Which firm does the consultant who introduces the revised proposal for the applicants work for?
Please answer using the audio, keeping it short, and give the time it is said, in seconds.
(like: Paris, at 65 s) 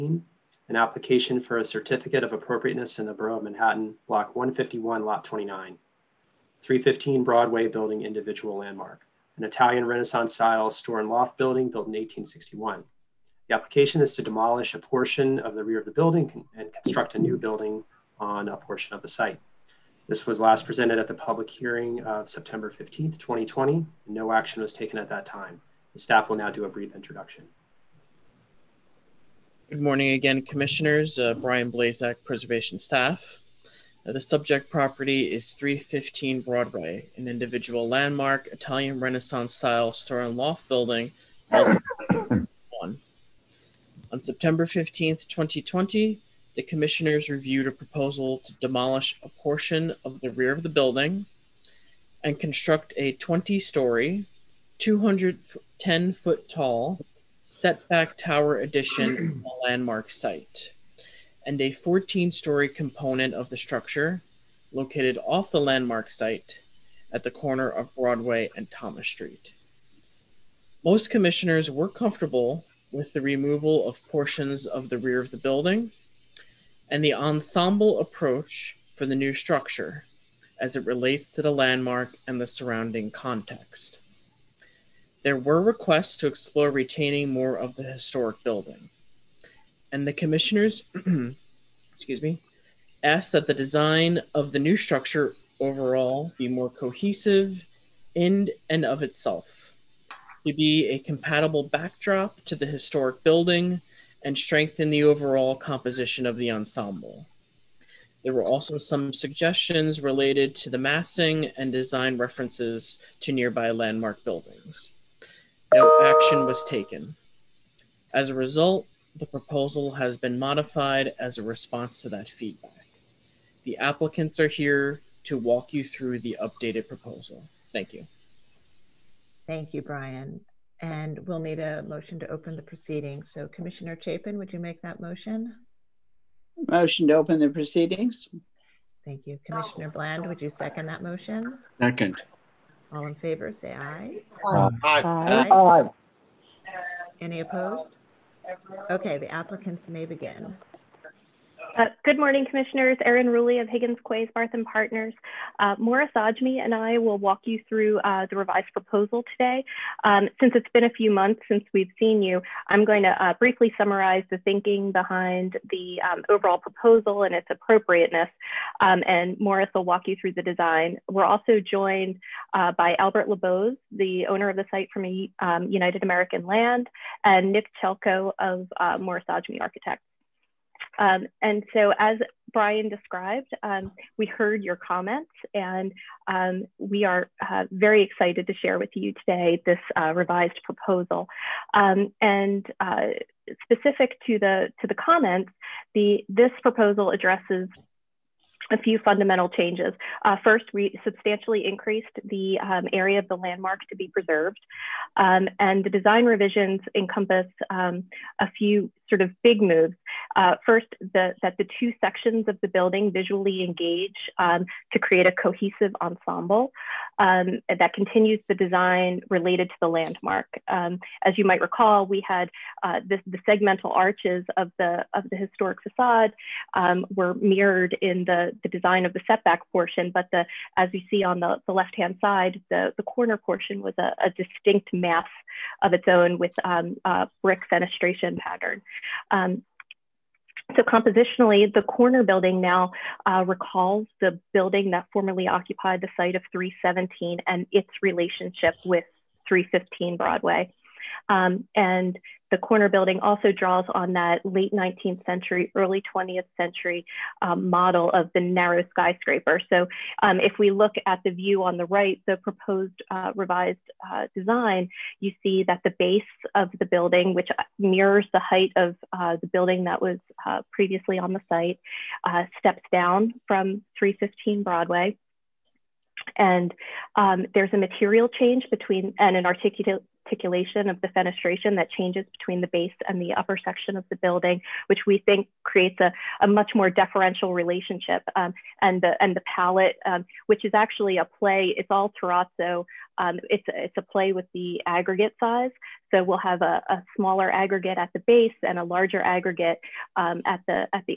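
Higgins, Quasebarth and Partners, at 153 s.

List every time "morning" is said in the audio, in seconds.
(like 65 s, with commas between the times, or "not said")
29 s, 152 s.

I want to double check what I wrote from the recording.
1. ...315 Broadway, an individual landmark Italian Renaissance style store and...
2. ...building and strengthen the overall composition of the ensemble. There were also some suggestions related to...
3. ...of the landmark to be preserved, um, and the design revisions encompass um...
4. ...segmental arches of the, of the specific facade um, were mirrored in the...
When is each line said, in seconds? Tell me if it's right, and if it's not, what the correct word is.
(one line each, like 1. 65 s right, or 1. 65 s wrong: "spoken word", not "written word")
1. 35 s right
2. 103 s right
3. 203 s right
4. 223 s wrong: "historic", not "specific".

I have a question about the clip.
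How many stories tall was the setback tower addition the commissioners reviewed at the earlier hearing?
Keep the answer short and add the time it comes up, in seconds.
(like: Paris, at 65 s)
20, at 53 s.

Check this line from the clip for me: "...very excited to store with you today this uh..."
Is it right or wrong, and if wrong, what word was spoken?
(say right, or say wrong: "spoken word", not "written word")
wrong: "share", not "store".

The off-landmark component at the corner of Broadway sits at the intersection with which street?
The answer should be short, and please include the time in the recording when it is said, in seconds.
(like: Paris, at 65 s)
Thomas Street, at 68 s.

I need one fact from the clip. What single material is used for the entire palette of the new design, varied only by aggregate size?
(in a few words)
Terrazzo.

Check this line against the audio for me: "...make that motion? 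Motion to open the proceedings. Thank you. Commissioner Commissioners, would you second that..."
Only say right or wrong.
wrong.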